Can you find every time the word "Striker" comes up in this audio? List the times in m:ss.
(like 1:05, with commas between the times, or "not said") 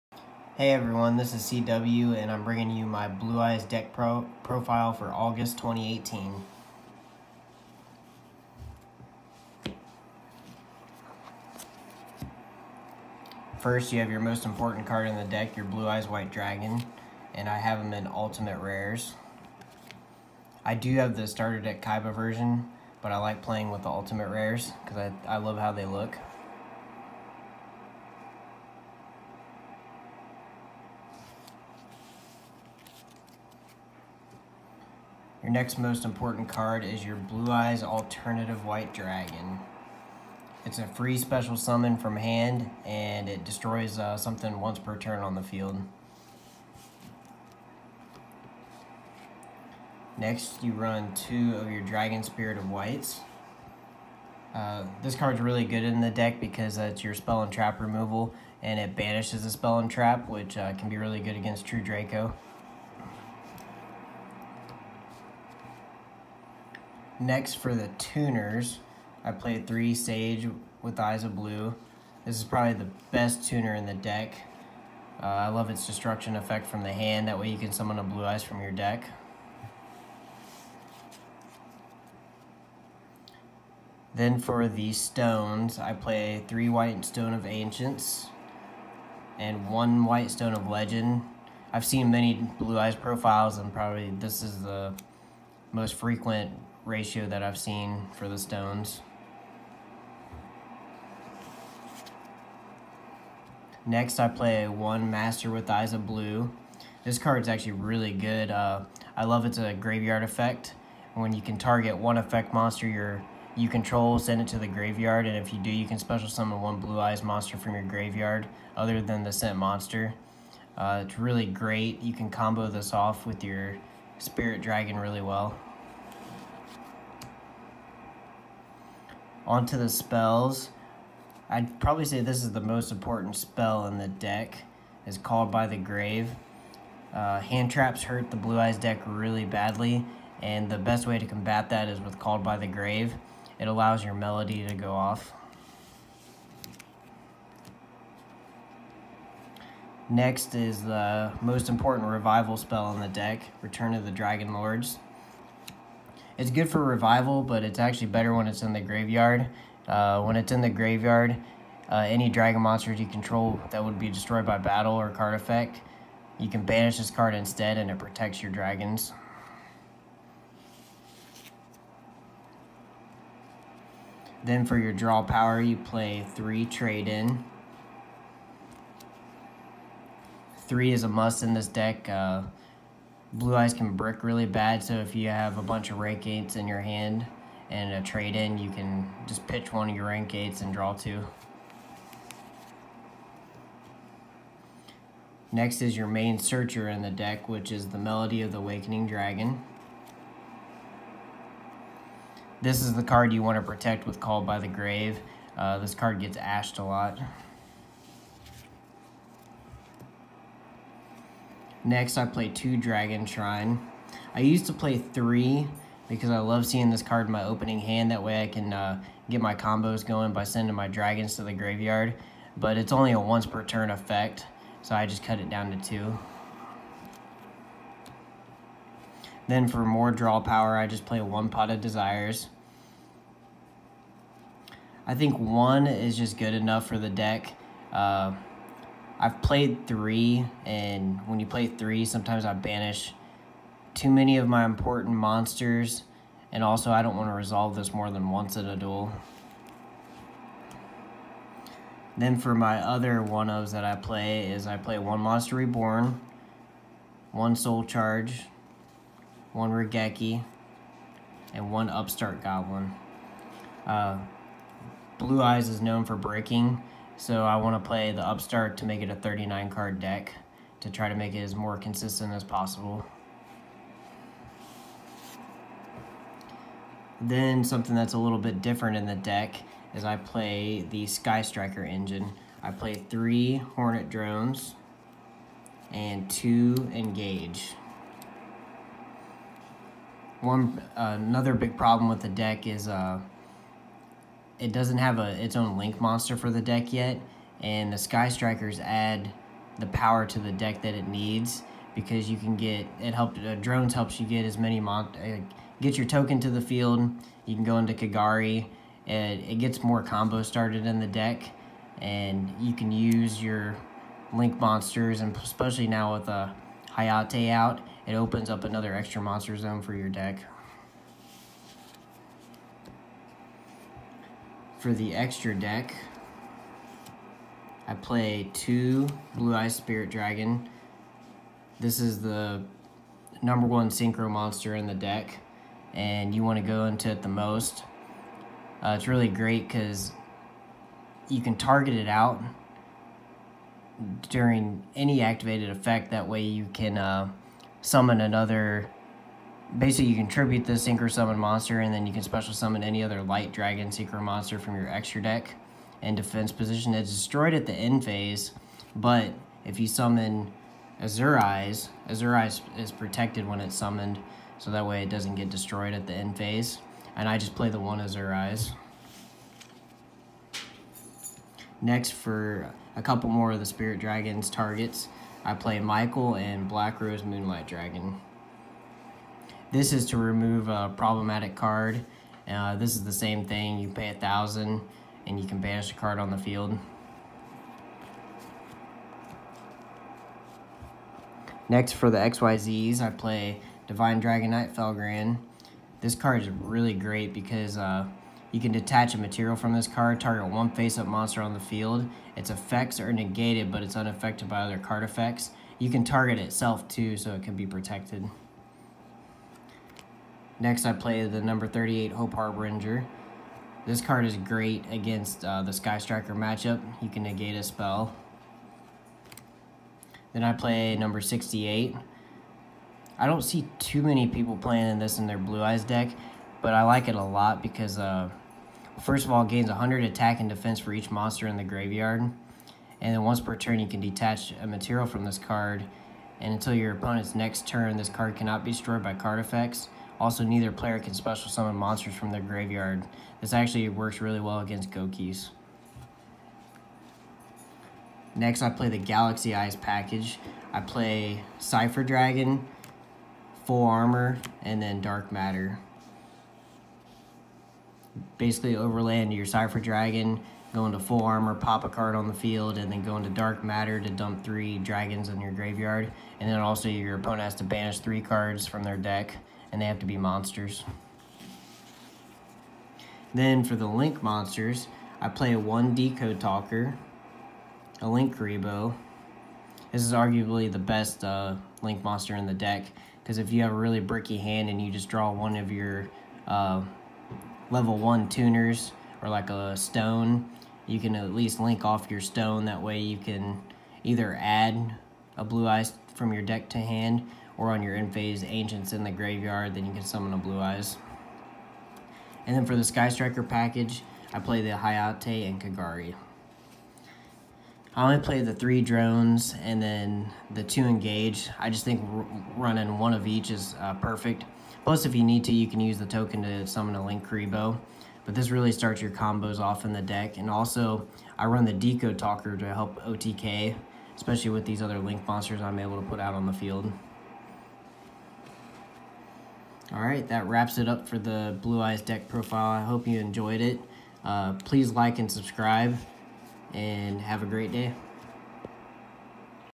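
4:41, 4:58, 6:55, 8:23.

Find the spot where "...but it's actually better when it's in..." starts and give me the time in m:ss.
2:37.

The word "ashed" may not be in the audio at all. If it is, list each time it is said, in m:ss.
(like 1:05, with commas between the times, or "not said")
3:26.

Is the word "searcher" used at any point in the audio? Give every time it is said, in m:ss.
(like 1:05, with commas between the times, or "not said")
3:16.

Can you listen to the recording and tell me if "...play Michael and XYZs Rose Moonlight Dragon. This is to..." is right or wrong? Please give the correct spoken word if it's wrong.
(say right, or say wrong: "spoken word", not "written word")
wrong: "Black", not "XYZs".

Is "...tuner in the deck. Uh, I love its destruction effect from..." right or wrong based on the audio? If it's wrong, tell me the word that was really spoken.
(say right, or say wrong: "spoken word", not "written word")
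right.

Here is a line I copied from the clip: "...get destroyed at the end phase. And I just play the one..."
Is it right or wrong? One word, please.
right.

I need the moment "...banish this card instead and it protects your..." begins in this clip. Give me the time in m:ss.
2:46.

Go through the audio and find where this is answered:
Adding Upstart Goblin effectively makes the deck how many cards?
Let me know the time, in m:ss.
4:29.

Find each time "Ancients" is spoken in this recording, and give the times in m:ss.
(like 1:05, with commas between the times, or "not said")
1:27, 8:18.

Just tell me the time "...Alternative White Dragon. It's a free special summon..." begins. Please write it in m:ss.
0:37.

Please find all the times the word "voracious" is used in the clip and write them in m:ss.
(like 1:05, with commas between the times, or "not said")
not said.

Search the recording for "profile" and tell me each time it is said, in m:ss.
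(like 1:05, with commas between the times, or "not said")
0:04, 1:32, 8:52.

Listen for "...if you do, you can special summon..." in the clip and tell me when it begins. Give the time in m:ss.
1:55.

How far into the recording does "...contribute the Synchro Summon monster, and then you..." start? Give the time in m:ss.
5:50.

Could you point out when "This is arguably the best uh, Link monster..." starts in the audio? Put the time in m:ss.
7:59.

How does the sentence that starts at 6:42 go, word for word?
Its effects are negated, but it's unaffected by other card effects.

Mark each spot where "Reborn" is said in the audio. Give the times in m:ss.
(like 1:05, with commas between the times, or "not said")
4:15.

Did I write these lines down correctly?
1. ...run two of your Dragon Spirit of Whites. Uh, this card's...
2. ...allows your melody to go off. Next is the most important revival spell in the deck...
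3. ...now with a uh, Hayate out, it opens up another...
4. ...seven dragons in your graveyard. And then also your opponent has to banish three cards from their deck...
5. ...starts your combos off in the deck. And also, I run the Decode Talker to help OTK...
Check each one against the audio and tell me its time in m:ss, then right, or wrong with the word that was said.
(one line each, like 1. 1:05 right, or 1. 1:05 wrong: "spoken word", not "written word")
1. 0:50 right
2. 2:23 right
3. 5:15 right
4. 7:44 wrong: "three", not "seven"
5. 8:38 right.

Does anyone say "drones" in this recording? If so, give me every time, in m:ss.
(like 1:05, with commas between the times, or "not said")
4:44, 5:03, 8:28.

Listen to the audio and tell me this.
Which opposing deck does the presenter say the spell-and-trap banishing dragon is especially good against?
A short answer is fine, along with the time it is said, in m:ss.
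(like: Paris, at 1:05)
True Draco, at 1:01.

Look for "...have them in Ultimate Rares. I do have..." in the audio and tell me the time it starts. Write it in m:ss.
0:17.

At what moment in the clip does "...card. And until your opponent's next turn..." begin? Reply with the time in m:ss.
7:15.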